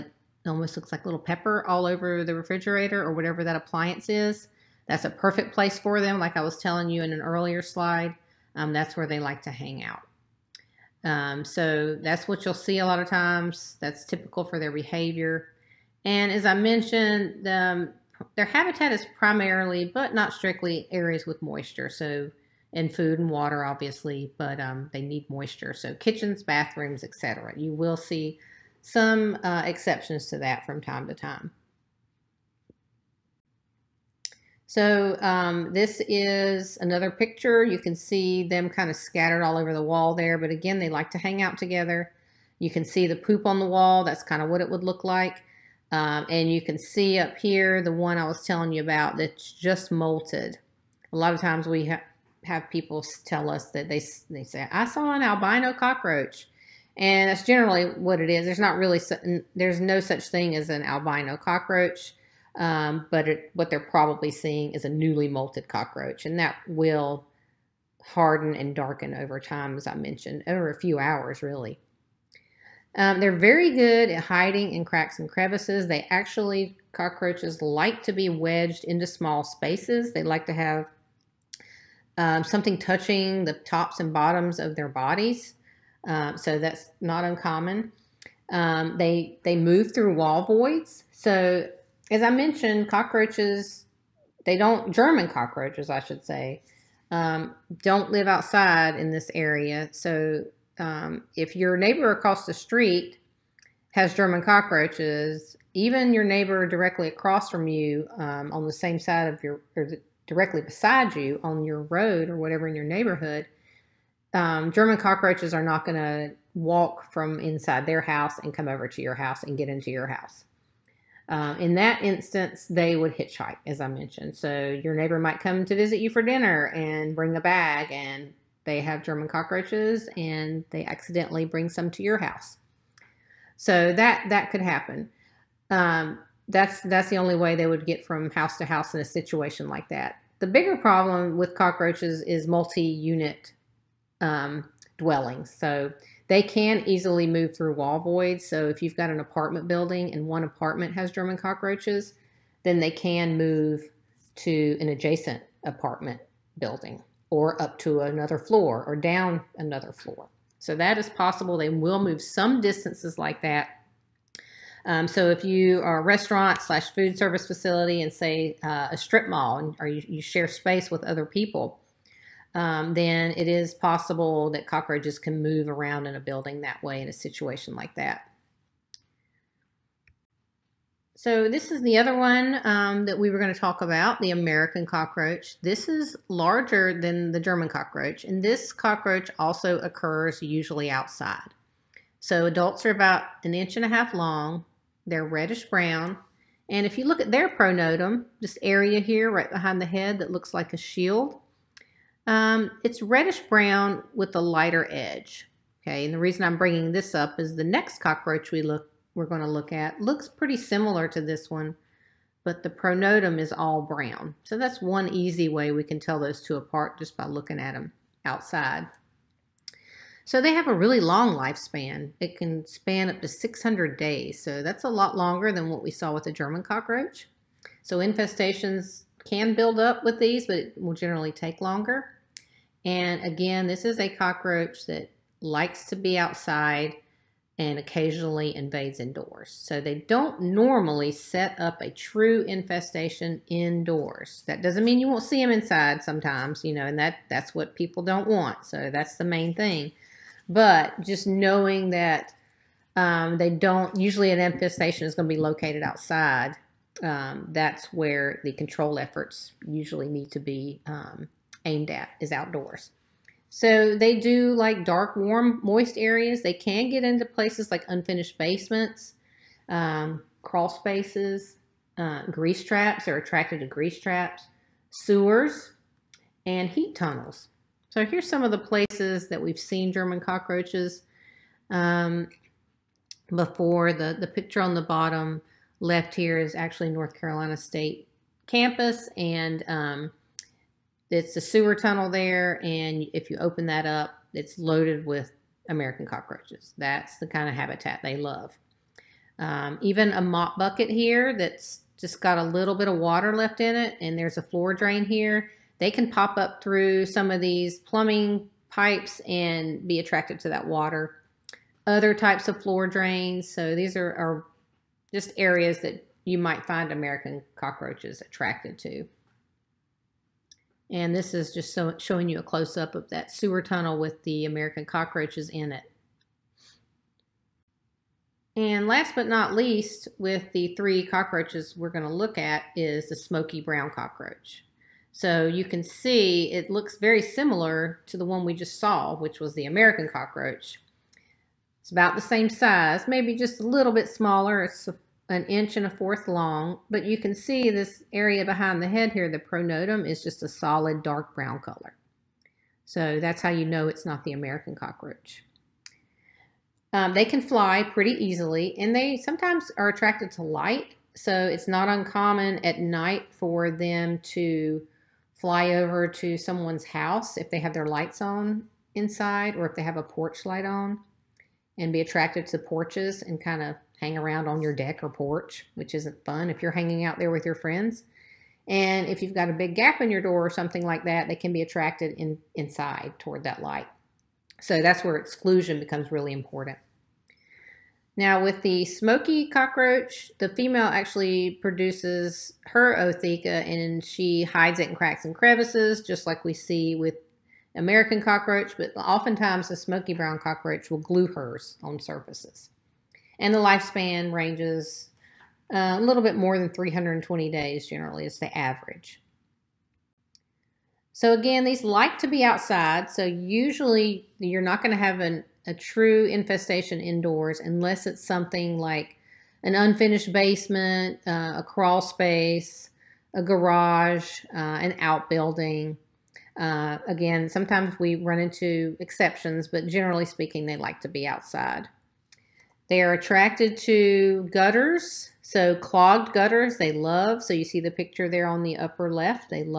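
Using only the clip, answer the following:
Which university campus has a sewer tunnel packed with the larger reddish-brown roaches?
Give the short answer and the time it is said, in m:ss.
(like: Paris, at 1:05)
North Carolina State, at 4:46.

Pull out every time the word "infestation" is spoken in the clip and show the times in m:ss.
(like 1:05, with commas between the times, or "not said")
3:47, 4:02, 4:14, 6:56.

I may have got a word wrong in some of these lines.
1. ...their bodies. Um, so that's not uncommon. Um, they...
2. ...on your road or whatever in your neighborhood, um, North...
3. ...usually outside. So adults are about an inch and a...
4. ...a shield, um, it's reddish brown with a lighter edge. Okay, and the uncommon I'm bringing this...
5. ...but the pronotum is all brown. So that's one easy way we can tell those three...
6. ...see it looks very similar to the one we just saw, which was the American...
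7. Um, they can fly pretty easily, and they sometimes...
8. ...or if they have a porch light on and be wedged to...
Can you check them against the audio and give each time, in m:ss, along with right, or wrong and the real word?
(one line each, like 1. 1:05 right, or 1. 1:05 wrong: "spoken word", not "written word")
1. 1:24 right
2. 1:51 wrong: "German", not "North"
3. 3:10 right
4. 3:20 wrong: "reason", not "uncommon"
5. 3:32 wrong: "two", not "three"
6. 5:35 right
7. 5:56 right
8. 6:09 wrong: "attracted", not "wedged".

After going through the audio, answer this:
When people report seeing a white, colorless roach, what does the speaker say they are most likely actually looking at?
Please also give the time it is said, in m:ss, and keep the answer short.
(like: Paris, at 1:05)
newly molted cockroach, at 1:04.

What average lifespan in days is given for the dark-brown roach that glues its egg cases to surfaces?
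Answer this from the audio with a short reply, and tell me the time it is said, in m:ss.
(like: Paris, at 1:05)
320 days, at 6:46.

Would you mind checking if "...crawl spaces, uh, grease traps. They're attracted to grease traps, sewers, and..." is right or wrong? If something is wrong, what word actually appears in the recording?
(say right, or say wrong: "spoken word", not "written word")
right.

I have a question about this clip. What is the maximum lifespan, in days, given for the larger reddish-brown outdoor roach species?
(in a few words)
600 days.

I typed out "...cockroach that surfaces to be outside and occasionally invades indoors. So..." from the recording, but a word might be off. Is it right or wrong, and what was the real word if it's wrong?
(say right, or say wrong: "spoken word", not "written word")
wrong: "likes", not "surfaces".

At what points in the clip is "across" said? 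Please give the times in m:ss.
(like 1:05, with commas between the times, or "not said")
1:42, 1:47.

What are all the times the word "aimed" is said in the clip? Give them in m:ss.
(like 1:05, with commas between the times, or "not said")
4:21.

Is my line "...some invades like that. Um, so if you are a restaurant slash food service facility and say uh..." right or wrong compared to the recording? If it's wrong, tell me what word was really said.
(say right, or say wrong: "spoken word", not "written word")
wrong: "distances", not "invades".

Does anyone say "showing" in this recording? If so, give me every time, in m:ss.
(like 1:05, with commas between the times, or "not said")
5:21.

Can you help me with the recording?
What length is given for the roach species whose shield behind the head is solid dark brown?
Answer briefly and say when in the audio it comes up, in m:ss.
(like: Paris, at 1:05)
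1.25 inches, at 5:45.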